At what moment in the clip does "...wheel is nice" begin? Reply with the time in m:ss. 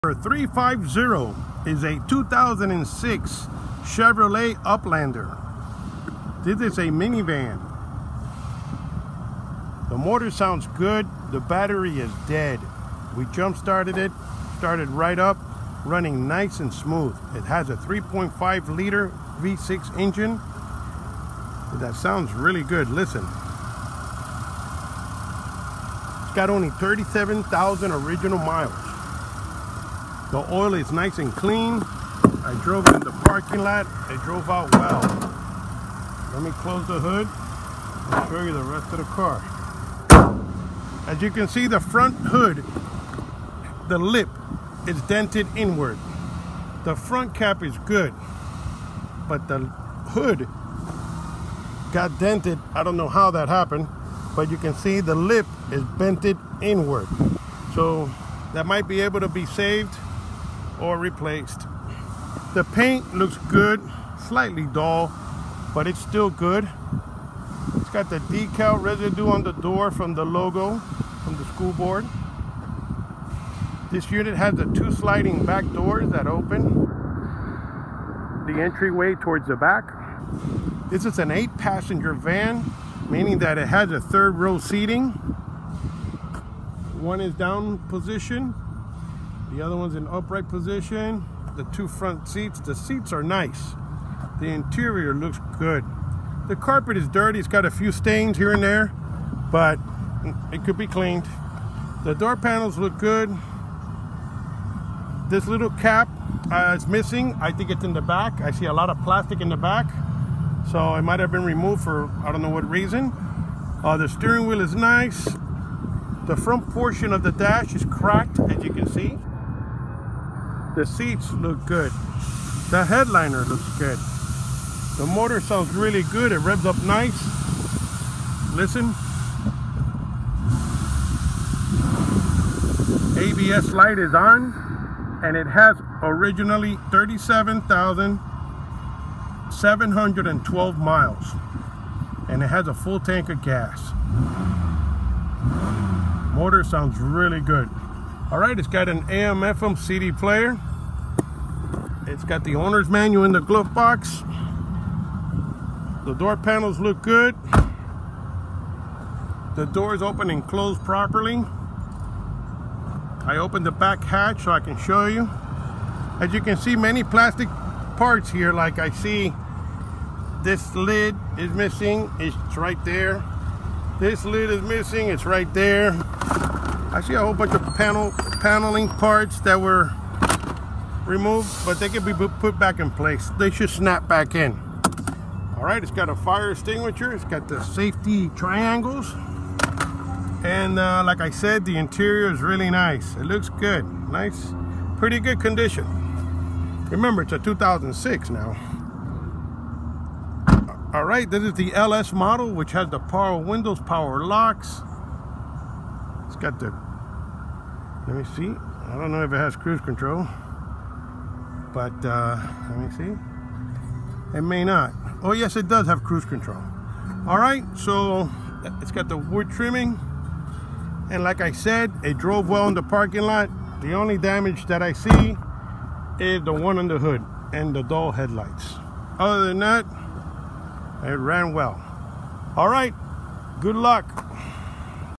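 1:54.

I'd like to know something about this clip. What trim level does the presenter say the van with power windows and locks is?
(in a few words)
LS.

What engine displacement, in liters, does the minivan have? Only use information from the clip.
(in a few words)
3.5 liter.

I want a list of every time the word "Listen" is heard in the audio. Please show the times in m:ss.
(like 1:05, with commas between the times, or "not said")
0:22, 2:08.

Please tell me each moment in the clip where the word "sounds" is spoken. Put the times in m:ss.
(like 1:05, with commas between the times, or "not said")
0:10, 0:21, 2:05, 2:26.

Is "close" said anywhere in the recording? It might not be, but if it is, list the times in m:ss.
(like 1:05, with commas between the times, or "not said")
0:36, 2:40.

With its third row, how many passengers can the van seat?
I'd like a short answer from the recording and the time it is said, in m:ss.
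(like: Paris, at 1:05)
8, at 1:21.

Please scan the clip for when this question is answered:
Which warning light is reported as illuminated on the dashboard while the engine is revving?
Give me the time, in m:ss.
2:13.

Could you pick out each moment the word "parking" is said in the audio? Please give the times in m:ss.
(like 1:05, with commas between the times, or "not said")
0:33, 3:42.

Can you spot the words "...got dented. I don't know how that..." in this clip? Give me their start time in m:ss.
0:51.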